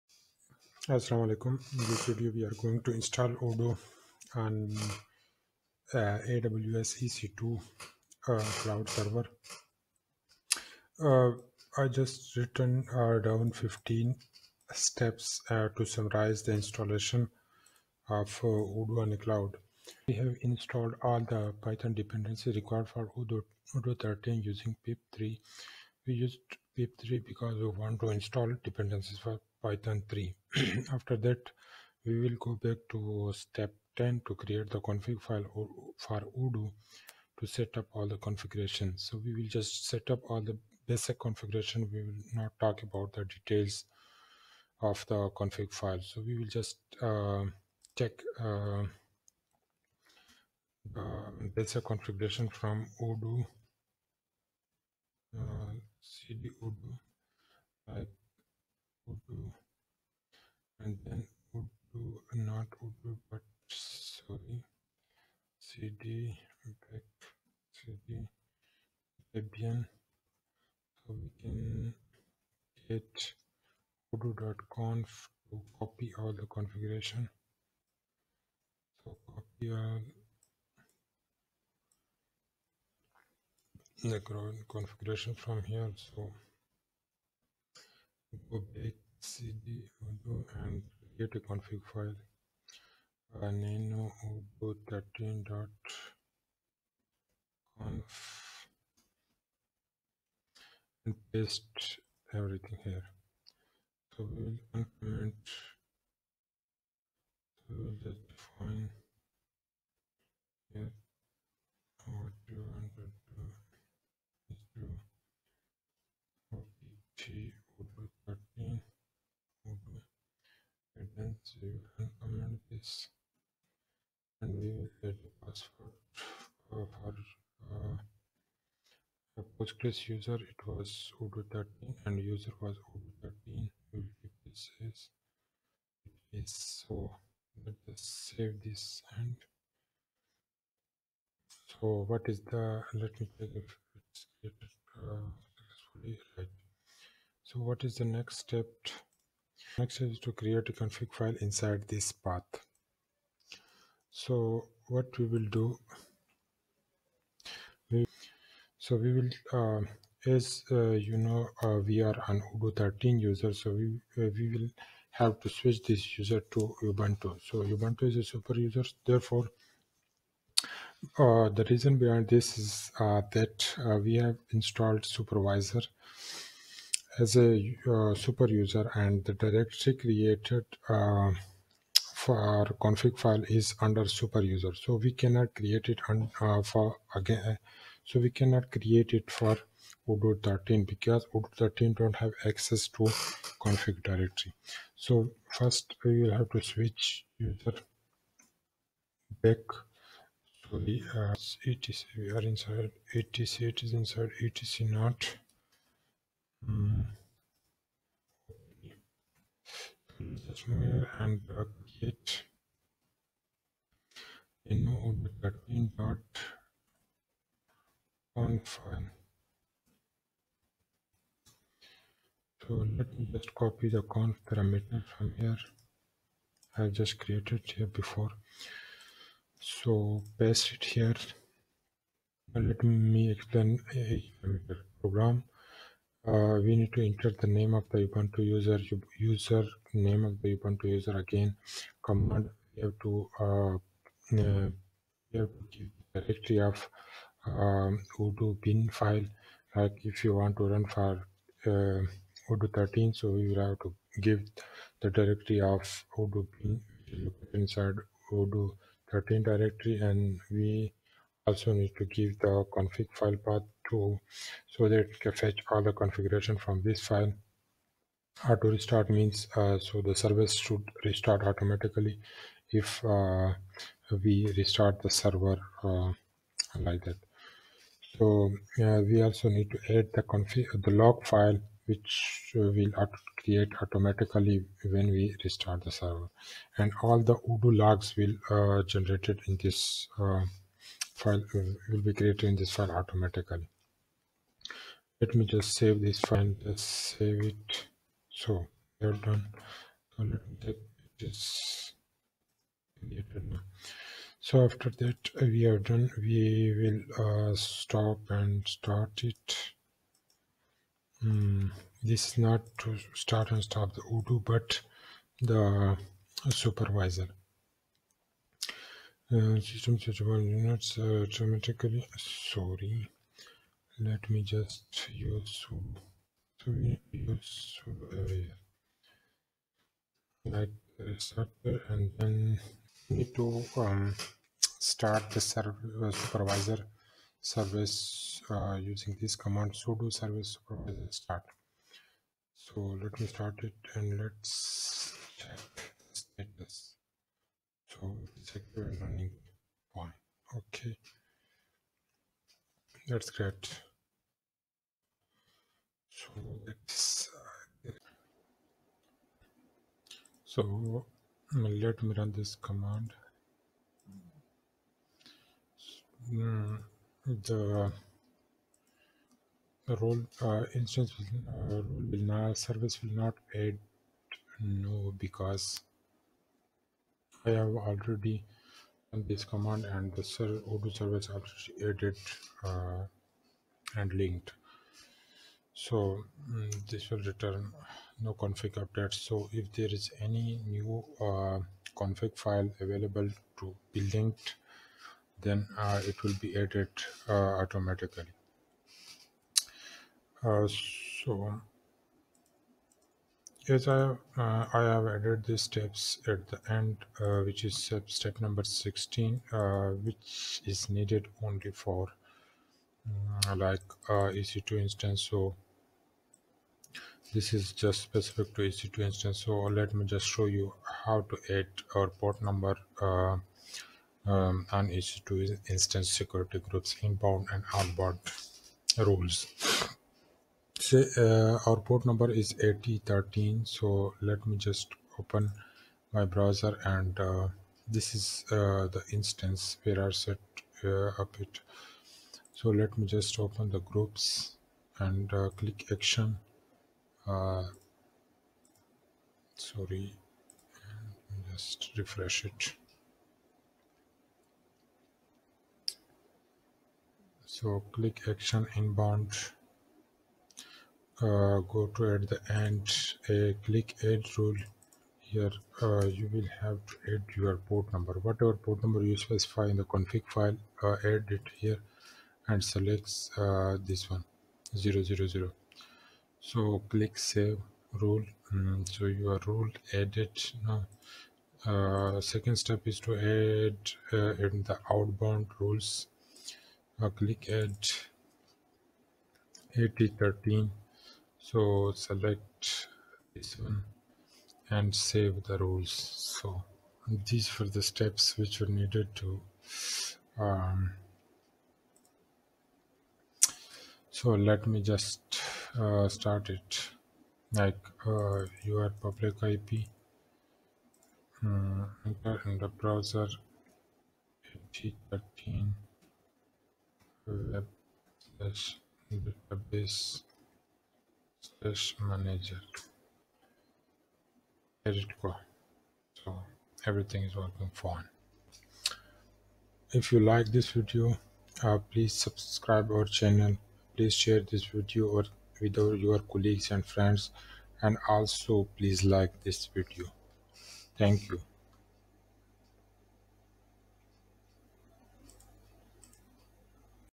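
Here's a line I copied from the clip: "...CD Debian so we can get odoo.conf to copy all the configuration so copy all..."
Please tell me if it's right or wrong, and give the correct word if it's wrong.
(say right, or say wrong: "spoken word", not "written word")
right.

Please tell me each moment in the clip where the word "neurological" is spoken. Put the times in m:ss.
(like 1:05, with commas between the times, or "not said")
not said.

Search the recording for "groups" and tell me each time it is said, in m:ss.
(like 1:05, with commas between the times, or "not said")
7:06, 7:23.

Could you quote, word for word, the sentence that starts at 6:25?
So mm, this will return no config updates.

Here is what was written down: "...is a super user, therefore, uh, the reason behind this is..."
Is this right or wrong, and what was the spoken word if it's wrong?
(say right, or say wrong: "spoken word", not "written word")
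right.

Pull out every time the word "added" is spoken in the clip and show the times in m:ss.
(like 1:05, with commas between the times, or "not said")
6:21, 6:36, 6:45, 7:59.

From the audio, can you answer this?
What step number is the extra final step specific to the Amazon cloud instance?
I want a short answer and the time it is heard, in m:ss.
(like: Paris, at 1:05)
16, at 6:48.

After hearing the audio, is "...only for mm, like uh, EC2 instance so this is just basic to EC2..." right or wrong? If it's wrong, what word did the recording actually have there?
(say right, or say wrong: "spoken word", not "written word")
wrong: "specific", not "basic".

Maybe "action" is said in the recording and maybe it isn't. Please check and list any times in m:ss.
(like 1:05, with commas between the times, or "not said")
7:25, 7:38.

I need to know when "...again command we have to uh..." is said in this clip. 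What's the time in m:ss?
4:01.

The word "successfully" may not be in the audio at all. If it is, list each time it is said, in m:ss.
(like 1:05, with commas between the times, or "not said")
2:25.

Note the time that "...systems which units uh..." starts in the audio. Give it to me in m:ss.
5:19.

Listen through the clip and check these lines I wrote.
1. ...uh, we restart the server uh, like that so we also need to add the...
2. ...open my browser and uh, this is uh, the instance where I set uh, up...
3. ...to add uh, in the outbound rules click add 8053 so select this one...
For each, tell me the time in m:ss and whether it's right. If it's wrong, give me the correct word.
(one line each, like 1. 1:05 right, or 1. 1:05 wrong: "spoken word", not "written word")
1. 4:33 right
2. 7:15 right
3. 8:02 wrong: "8013", not "8053".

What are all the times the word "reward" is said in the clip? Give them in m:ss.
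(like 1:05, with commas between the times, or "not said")
not said.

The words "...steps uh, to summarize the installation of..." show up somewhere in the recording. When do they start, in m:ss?
0:14.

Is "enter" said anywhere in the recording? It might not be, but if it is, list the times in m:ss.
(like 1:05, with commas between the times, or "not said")
3:57, 8:32.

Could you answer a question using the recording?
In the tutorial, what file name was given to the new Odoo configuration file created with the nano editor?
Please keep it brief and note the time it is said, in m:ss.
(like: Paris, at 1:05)
odoo13.conf, at 1:34.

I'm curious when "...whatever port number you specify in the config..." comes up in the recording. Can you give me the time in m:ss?
7:48.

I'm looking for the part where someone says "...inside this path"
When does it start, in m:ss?
2:31.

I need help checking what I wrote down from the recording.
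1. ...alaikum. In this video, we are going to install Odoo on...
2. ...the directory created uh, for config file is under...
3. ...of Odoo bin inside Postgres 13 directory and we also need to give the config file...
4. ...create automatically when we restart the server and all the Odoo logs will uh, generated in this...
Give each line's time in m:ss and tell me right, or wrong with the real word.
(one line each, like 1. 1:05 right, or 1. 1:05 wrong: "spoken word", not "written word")
1. 0:01 right
2. 2:59 right
3. 4:15 wrong: "Odoo", not "Postgres"
4. 4:43 right.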